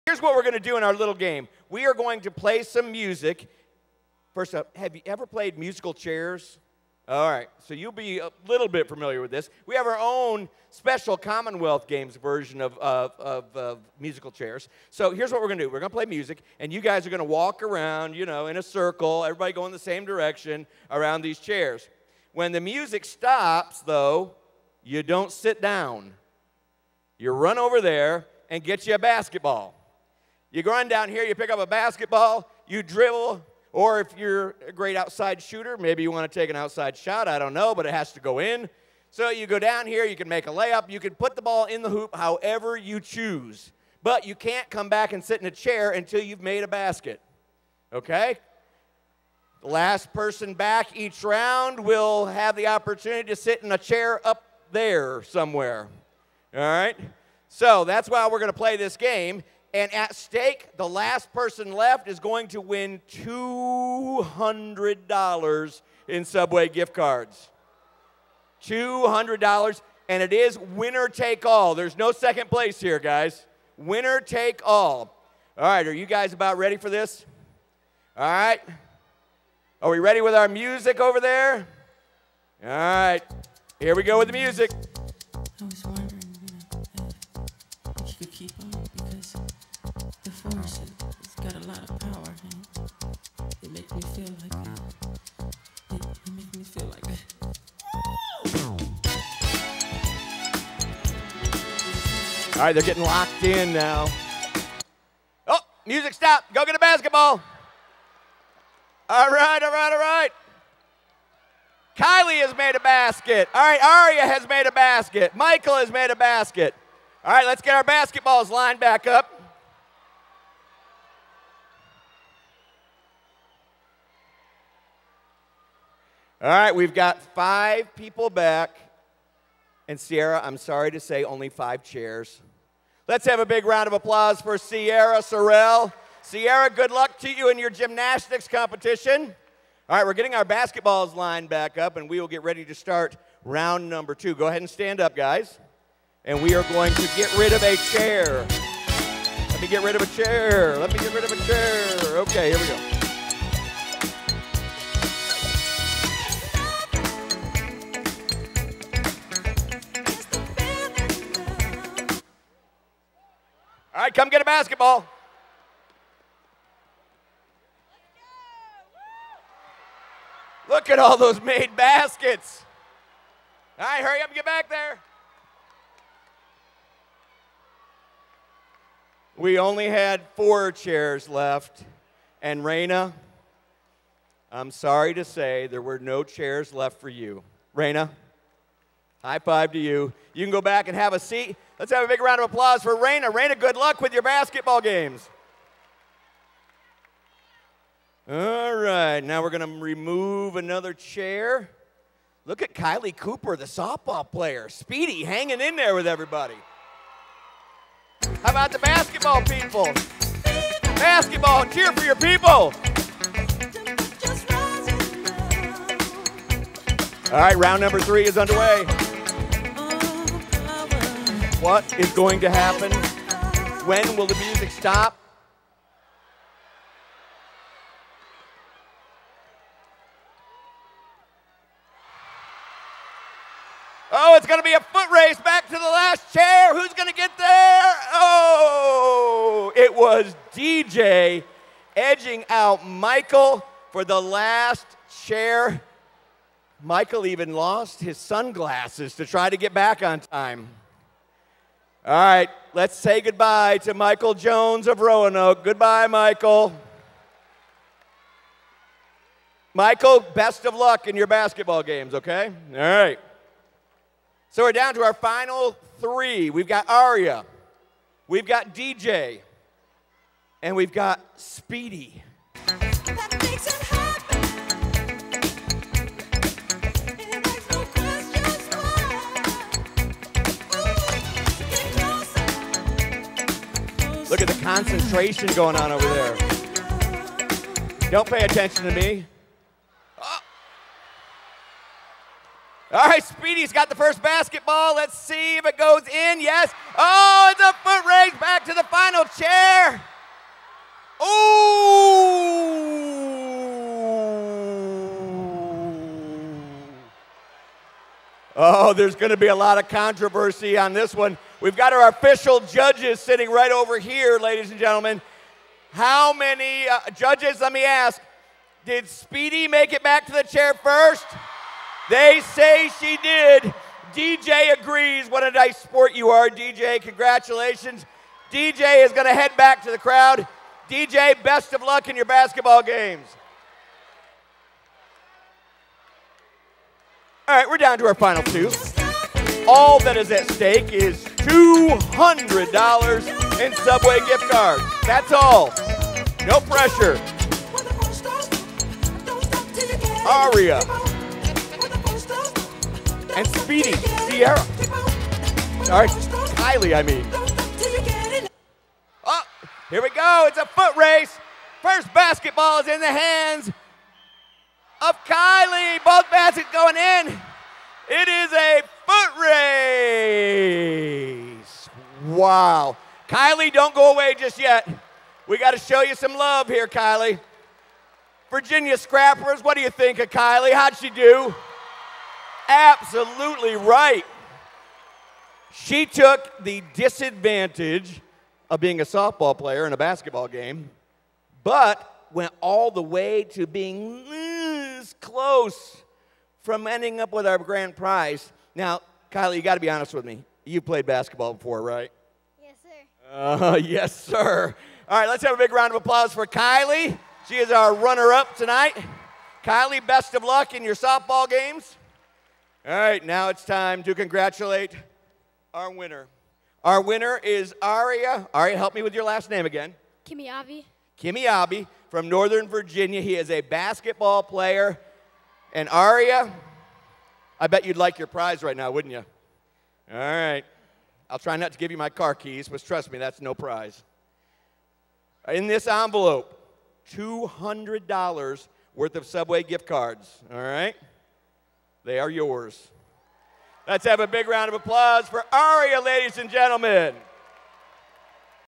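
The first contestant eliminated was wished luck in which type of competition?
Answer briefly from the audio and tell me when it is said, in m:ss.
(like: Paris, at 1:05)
gymnastics, at 2:17.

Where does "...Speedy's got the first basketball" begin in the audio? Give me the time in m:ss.
4:53.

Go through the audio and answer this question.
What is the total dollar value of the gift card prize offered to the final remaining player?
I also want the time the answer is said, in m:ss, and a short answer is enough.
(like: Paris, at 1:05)
$200, at 1:08.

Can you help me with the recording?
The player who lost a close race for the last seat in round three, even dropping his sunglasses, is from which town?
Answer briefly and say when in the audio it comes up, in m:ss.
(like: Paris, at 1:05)
Roanoke, at 4:15.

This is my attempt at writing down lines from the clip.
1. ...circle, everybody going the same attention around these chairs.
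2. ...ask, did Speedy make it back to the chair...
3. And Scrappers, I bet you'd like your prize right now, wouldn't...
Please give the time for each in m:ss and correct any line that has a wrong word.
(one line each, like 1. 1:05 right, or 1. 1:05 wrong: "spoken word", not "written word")
1. 0:18 wrong: "direction", not "attention"
2. 5:17 right
3. 7:05 wrong: "Aria", not "Scrappers".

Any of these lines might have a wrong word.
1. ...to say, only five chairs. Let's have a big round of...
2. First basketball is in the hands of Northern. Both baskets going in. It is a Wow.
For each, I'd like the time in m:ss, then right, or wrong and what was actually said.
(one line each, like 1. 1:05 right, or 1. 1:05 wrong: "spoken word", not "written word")
1. 2:10 right
2. 6:01 wrong: "Kylie", not "Northern".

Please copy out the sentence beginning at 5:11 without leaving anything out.
We've got our official judges sitting right over here, ladies and gentlemen.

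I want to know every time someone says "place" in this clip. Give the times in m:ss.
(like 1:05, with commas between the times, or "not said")
1:12.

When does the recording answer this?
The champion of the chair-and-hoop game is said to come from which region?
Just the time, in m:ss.
7:02.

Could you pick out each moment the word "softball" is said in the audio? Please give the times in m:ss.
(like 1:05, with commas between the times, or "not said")
3:23, 6:29, 6:50.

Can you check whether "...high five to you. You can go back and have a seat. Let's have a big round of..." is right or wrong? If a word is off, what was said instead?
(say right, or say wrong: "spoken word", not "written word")
right.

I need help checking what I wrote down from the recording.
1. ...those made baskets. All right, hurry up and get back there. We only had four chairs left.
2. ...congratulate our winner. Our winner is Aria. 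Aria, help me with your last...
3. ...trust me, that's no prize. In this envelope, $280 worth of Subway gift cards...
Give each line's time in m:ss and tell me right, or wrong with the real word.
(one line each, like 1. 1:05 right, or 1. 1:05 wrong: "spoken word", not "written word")
1. 2:51 right
2. 6:54 right
3. 7:12 wrong: "200", not "280".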